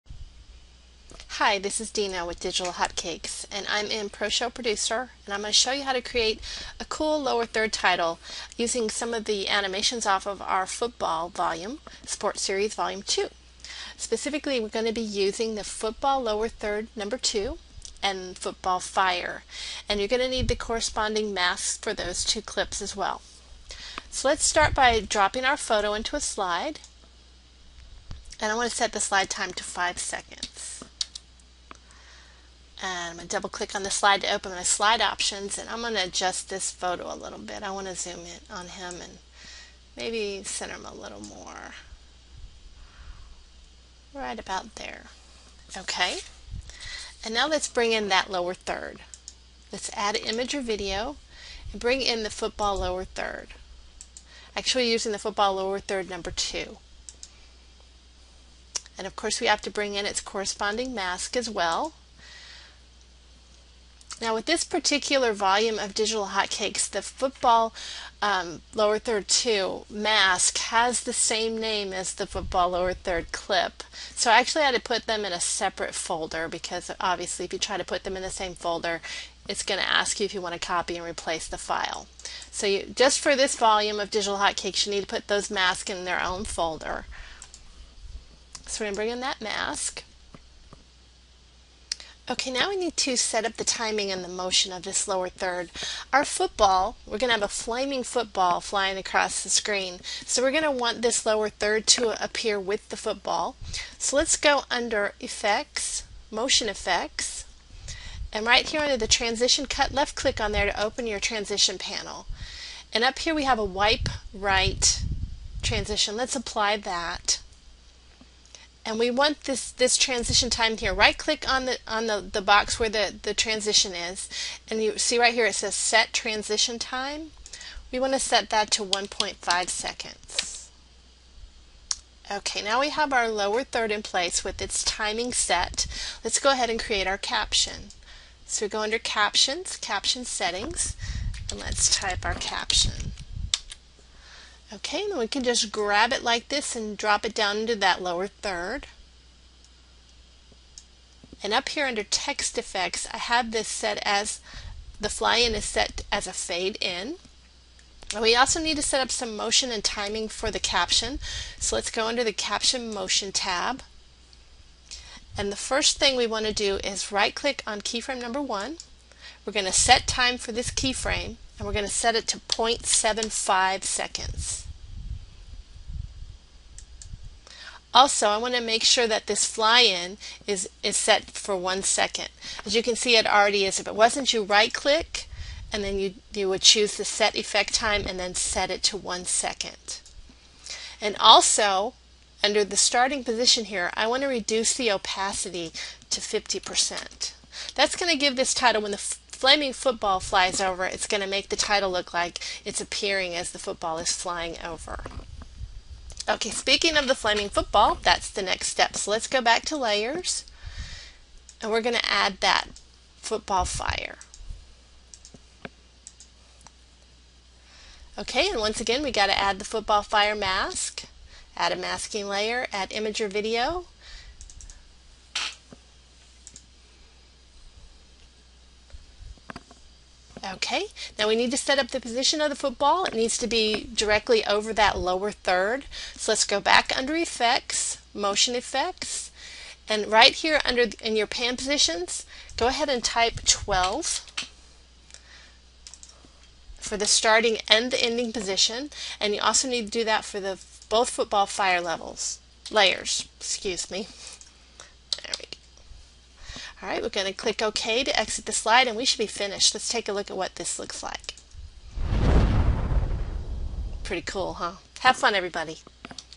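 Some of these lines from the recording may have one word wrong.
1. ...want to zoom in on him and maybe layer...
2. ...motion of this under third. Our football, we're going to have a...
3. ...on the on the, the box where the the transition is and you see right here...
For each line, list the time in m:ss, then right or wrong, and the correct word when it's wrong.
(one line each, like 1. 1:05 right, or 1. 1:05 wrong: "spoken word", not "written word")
1. 0:37 wrong: "center", not "layer"
2. 1:34 wrong: "lower", not "under"
3. 2:01 right.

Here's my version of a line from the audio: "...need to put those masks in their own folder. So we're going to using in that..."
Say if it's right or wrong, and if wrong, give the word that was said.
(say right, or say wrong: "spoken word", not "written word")
wrong: "bring", not "using".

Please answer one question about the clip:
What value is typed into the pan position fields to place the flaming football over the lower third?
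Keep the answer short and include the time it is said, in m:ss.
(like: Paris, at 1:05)
12, at 4:03.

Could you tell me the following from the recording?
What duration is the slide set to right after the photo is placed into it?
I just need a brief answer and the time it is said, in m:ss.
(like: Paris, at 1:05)
5 seconds, at 0:29.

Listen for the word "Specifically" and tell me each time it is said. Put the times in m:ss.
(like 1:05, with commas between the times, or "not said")
0:13.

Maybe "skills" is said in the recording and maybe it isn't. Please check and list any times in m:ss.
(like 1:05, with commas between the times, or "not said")
not said.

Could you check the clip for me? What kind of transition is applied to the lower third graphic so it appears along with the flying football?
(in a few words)
Wipe Right.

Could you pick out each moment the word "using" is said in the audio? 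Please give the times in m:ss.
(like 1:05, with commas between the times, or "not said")
0:08, 0:14, 0:54.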